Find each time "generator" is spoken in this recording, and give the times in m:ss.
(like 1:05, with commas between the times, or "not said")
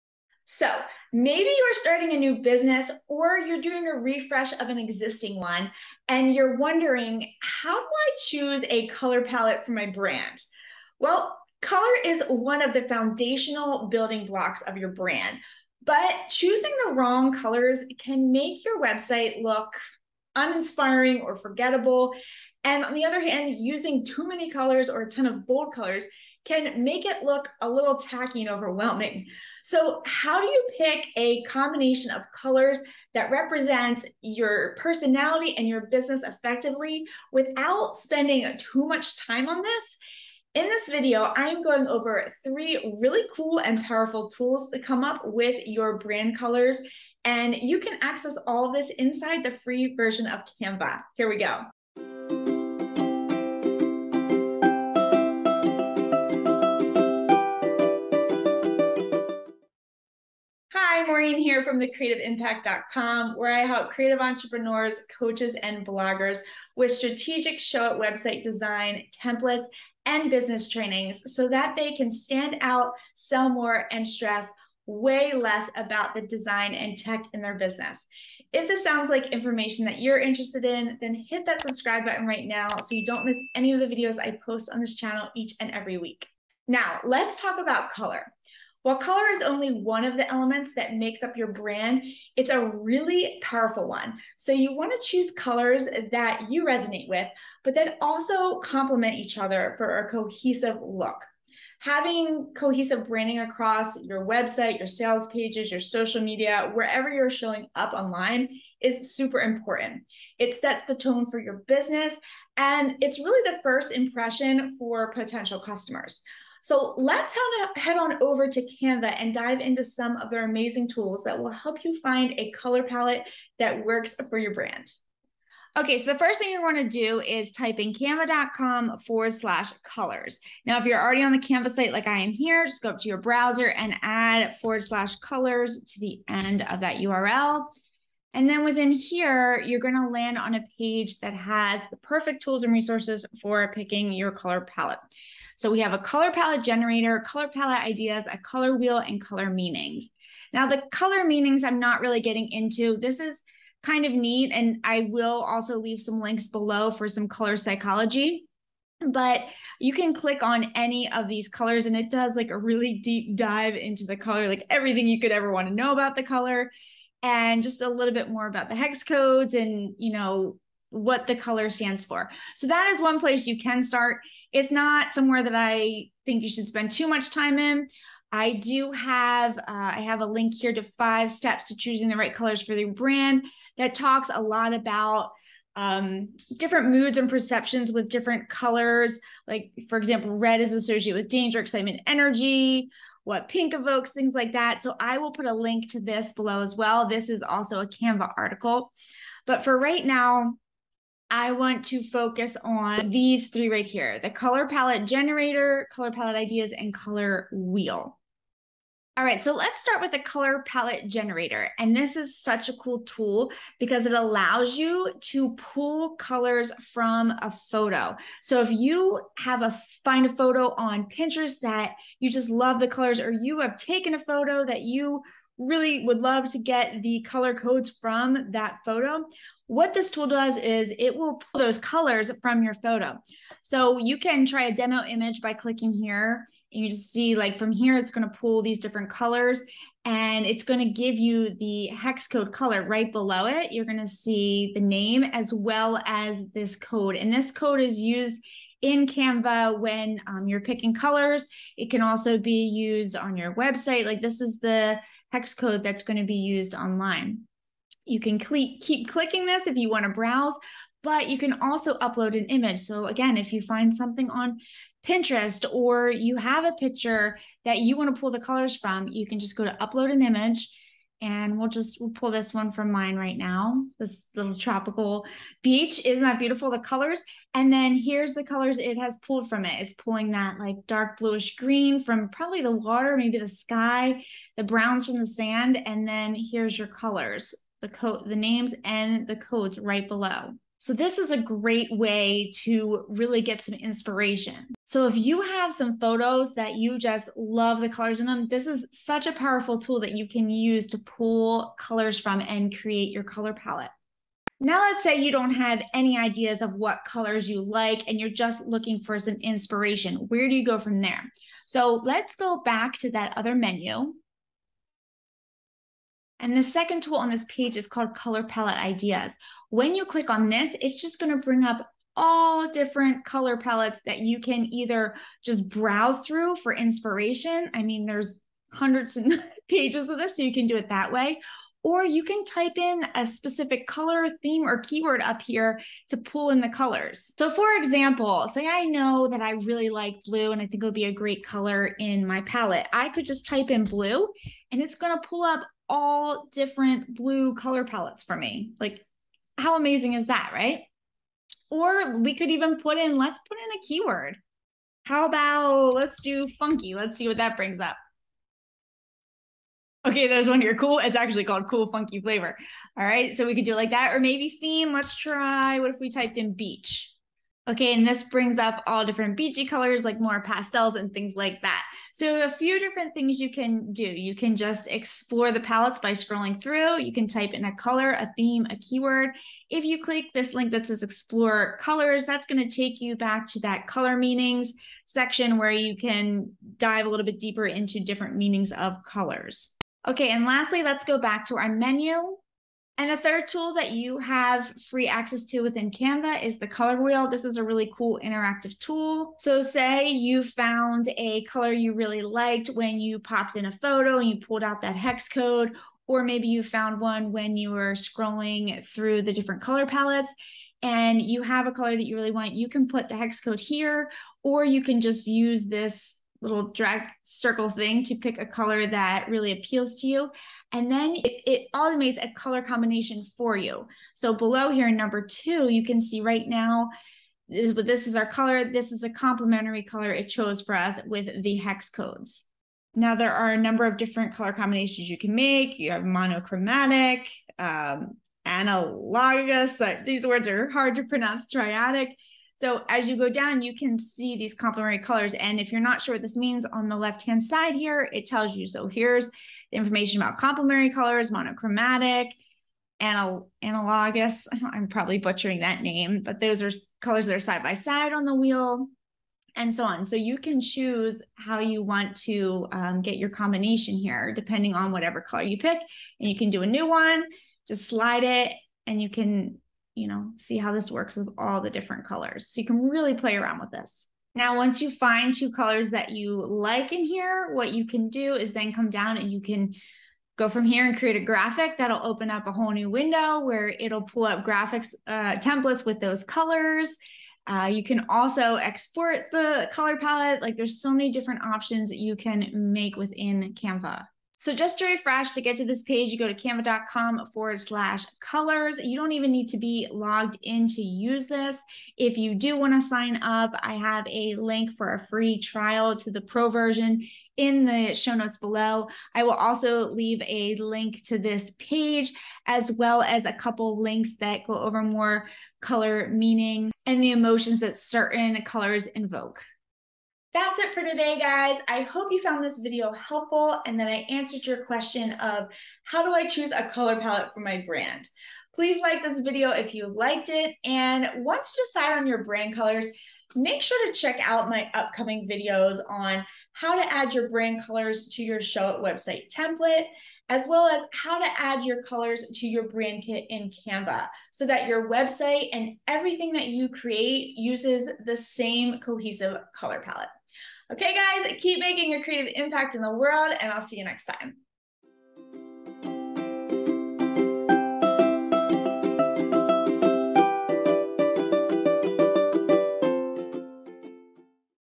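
2:26, 3:25, 3:31.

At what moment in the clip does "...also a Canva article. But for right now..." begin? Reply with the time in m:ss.
3:17.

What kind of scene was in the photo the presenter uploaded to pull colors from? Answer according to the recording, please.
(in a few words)
Tropical beach.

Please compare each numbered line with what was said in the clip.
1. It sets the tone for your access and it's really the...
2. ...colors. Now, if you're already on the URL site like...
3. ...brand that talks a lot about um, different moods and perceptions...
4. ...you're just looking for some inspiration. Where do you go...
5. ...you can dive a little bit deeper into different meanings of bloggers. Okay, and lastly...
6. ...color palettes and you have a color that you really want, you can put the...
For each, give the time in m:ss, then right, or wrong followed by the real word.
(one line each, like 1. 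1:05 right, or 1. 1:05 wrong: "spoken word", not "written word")
1. 1:50 wrong: "business", not "access"
2. 2:09 wrong: "Canva", not "URL"
3. 3:02 right
4. 5:08 right
5. 6:25 wrong: "colors", not "bloggers"
6. 6:49 right.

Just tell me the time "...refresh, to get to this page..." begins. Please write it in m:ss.
8:14.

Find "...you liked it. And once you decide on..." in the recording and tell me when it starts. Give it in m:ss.
8:49.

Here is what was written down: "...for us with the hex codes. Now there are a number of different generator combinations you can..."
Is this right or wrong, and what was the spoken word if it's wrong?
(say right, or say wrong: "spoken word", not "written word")
wrong: "color", not "generator".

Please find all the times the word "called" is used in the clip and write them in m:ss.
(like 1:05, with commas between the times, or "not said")
5:17, 6:01.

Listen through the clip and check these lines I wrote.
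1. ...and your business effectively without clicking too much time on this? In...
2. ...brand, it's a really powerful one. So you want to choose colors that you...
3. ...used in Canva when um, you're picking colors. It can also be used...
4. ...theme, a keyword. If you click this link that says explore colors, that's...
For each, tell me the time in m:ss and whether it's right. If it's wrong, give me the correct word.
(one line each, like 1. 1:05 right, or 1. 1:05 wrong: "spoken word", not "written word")
1. 0:35 wrong: "spending", not "clicking"
2. 1:31 right
3. 4:07 right
4. 6:18 right.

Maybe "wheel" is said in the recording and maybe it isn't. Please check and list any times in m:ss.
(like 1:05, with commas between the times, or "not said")
2:28, 3:27, 6:37, 7:38.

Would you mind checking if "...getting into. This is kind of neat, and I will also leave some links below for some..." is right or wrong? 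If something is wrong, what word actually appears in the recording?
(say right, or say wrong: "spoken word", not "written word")
right.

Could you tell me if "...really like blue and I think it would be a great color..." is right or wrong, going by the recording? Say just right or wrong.
right.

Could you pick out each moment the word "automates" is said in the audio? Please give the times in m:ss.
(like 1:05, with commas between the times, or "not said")
7:01.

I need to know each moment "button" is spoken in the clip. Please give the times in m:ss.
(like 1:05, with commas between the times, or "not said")
1:22.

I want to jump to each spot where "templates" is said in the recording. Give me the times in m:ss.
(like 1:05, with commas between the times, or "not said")
1:09, 8:05, 8:59.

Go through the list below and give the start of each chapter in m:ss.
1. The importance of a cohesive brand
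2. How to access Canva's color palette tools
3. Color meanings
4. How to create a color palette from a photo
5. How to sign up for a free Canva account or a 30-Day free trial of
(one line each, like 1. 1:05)
1. 1:26
2. 2:05
3. 2:30
4. 4:21
5. 8:22.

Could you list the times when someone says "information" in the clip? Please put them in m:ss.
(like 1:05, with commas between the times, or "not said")
1:19, 7:29.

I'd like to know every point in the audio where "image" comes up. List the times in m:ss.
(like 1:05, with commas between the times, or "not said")
3:55, 4:22, 4:30.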